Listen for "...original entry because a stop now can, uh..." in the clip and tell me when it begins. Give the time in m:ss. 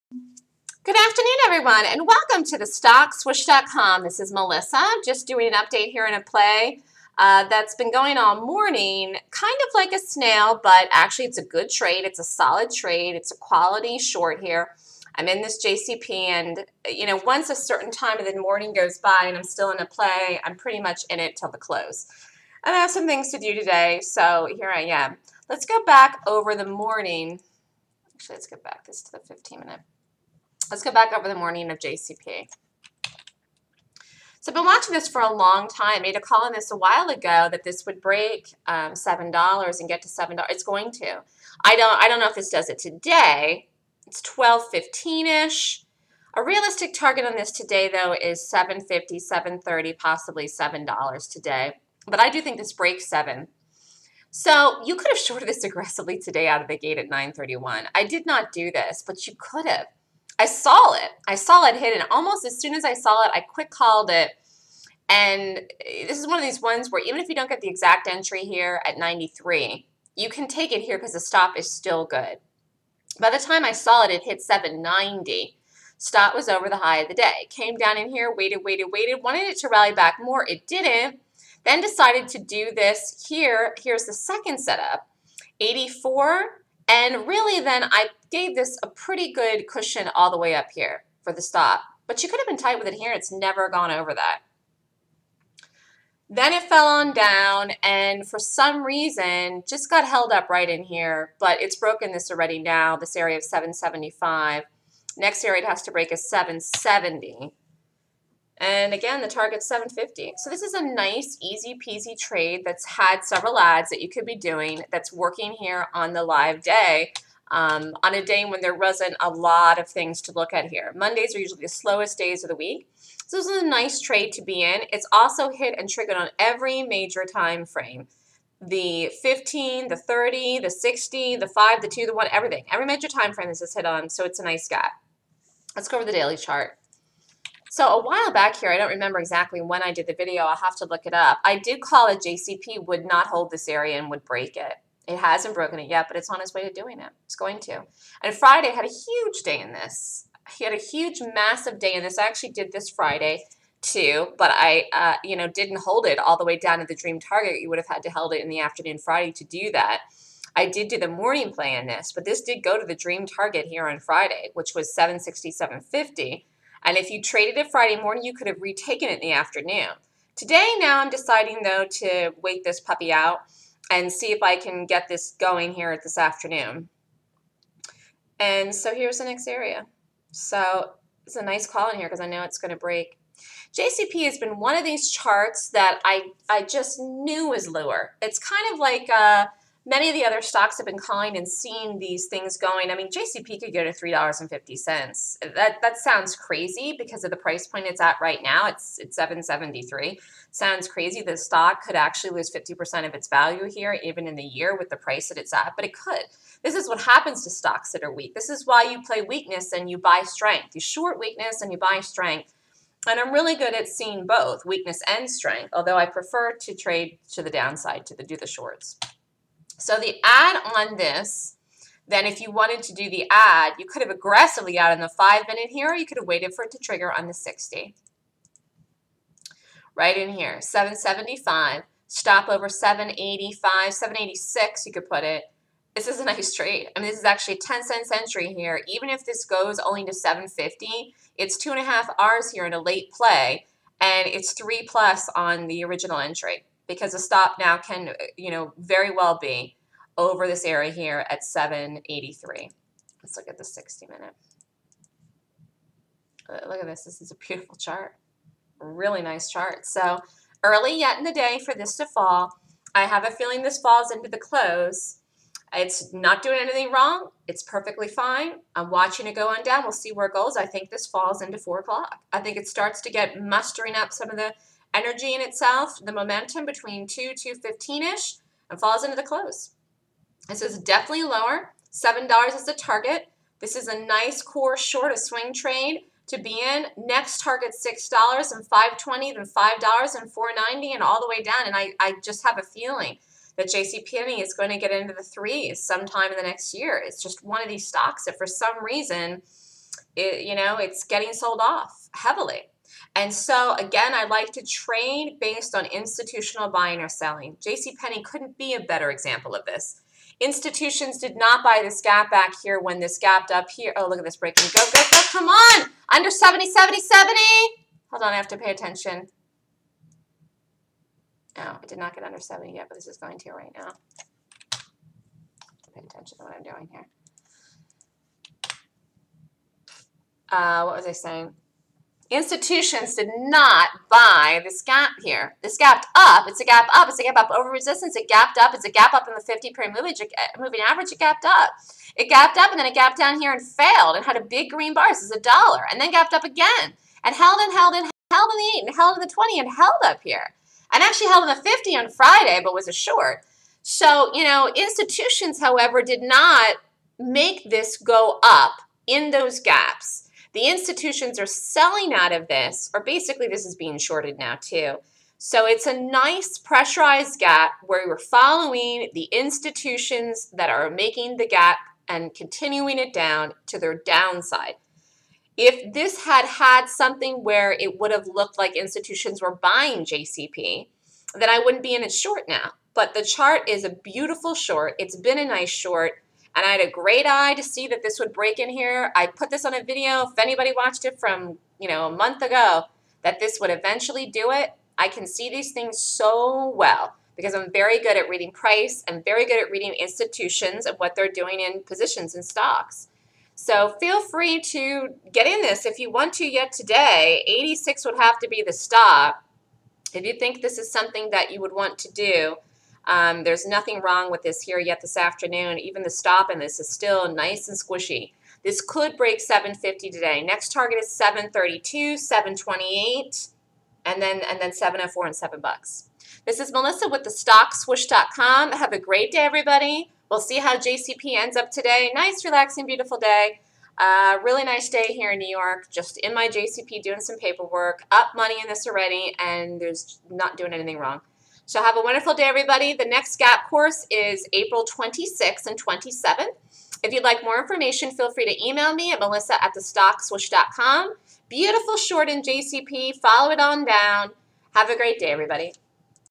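4:05.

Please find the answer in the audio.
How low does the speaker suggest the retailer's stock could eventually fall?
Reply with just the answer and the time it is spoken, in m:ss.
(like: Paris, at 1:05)
$3.50, at 3:13.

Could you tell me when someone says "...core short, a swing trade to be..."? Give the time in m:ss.
4:44.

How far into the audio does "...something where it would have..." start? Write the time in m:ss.
6:16.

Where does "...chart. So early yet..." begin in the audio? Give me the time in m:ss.
4:19.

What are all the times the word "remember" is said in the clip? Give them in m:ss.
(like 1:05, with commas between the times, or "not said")
2:18.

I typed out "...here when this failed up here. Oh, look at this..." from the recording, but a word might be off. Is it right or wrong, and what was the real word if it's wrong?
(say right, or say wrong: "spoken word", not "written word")
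wrong: "gapped", not "failed".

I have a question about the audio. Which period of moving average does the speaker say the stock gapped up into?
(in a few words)
50.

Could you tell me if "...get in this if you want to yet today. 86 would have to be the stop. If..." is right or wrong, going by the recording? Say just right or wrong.
right.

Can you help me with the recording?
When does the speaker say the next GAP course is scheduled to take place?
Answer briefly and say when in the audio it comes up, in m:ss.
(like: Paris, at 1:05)
April 26th and 27th, at 7:24.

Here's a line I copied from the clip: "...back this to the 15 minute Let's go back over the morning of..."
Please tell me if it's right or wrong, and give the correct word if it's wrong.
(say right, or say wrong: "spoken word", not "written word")
right.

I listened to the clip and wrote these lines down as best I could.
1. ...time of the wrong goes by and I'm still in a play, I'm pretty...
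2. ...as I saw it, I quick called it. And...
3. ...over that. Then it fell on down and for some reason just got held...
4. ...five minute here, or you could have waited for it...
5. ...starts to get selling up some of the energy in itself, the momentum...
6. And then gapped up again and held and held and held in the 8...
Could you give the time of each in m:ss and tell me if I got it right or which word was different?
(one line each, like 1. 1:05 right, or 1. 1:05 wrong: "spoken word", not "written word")
1. 0:17 wrong: "morning", not "wrong"
2. 1:02 right
3. 1:33 right
4. 3:45 right
5. 4:32 wrong: "mustering", not "selling"
6. 5:45 right.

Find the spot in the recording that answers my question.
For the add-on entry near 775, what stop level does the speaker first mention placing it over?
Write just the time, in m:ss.
3:52.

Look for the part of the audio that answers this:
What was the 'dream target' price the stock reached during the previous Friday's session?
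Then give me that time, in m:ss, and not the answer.
2:44.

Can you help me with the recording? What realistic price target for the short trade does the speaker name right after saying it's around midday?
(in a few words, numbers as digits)
$7.50.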